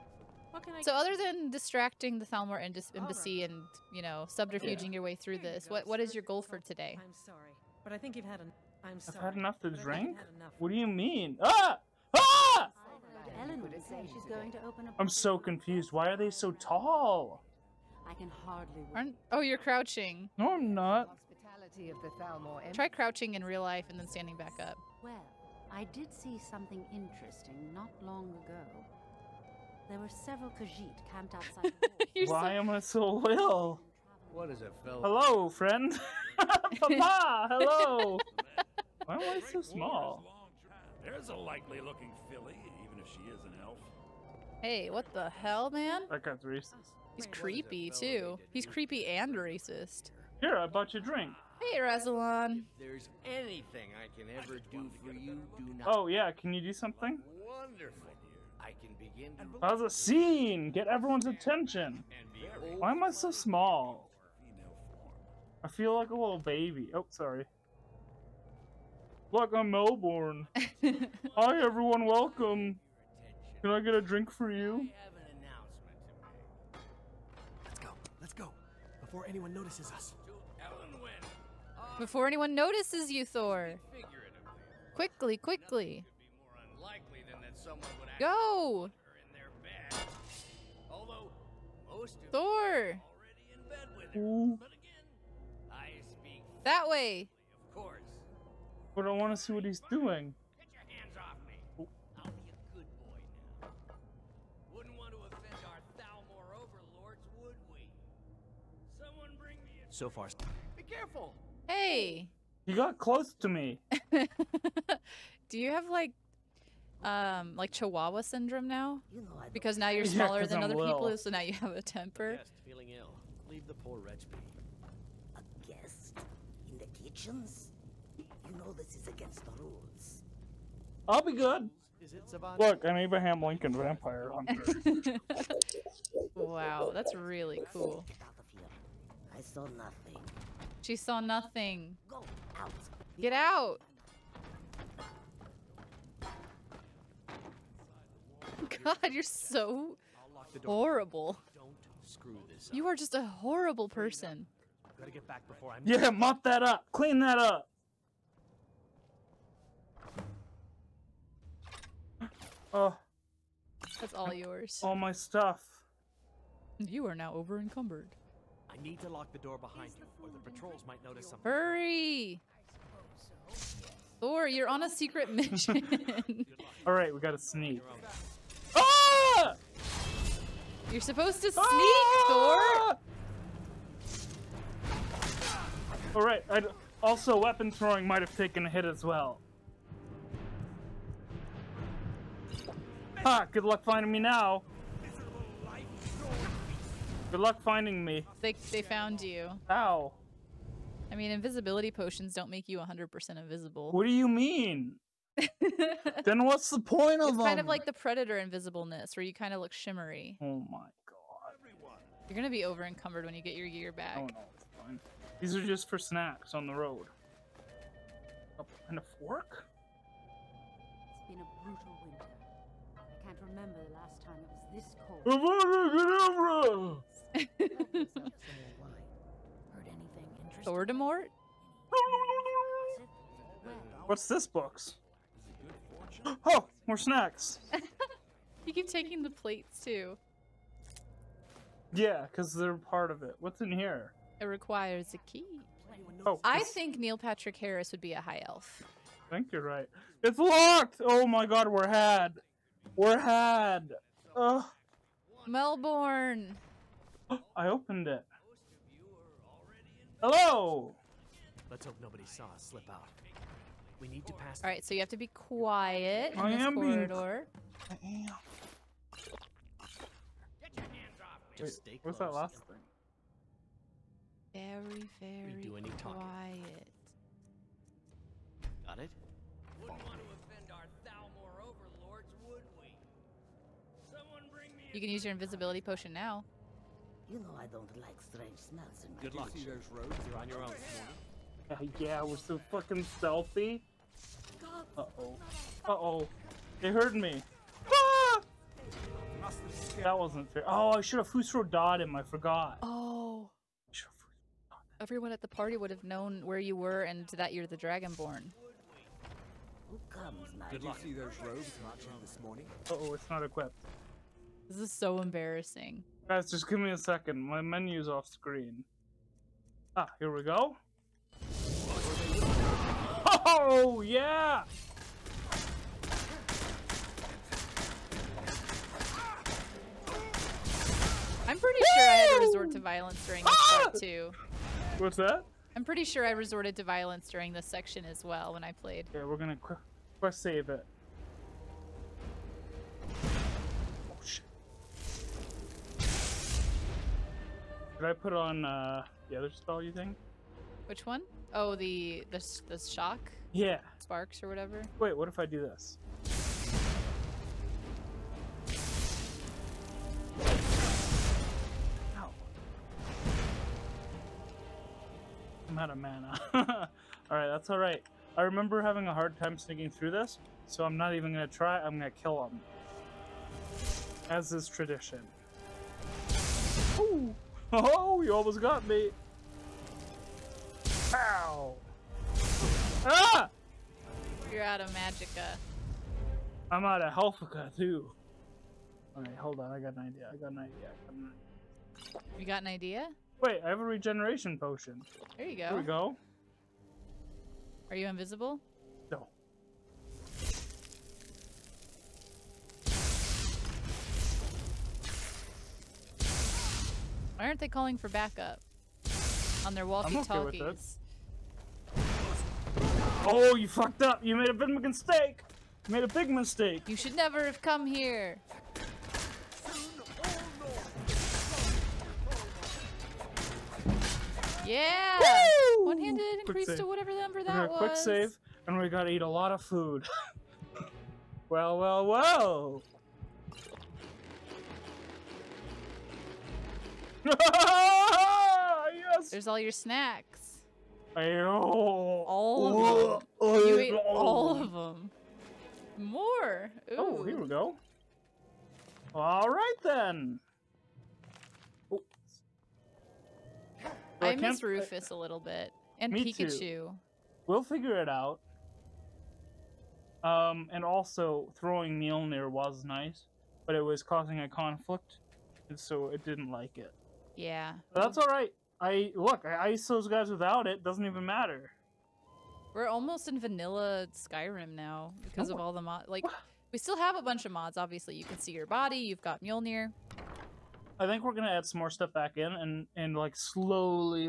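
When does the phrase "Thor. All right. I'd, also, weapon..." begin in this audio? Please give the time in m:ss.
3:02.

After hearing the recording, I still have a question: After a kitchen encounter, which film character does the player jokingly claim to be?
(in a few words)
Abraham Lincoln vampire hunter.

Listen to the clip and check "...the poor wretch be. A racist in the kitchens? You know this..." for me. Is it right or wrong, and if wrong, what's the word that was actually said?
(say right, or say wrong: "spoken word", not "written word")
wrong: "guest", not "racist".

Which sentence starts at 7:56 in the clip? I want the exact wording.
Like, we still have a bunch of mods.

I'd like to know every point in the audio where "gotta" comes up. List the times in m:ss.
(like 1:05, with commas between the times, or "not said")
2:57, 7:08.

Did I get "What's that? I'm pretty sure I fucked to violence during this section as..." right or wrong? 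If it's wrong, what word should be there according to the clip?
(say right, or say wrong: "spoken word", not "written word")
wrong: "resorted", not "fucked".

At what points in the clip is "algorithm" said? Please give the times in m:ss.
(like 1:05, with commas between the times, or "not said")
not said.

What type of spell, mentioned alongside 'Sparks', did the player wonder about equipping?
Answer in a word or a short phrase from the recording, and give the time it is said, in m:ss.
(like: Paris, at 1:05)
Shock, at 5:52.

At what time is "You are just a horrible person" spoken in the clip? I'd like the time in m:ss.
2:32.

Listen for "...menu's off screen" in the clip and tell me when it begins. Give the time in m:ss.
5:17.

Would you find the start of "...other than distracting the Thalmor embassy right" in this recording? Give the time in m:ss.
0:00.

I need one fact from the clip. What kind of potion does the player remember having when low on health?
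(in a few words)
Regeneration potion.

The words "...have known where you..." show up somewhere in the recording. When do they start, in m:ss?
5:05.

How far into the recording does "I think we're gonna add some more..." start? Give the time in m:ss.
8:00.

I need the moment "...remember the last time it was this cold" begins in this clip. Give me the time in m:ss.
3:43.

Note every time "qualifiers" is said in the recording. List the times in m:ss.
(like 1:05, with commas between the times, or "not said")
not said.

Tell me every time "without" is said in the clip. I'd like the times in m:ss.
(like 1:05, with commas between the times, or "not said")
7:50.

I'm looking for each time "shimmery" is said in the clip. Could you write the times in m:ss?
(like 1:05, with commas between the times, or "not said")
3:29.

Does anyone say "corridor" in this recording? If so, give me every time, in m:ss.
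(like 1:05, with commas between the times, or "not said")
4:26.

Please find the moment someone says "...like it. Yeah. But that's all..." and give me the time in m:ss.
7:46.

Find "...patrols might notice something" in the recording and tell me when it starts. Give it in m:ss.
2:50.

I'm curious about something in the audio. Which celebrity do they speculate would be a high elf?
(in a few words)
Neil Patrick Harris.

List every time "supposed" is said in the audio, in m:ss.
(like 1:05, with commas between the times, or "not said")
3:01.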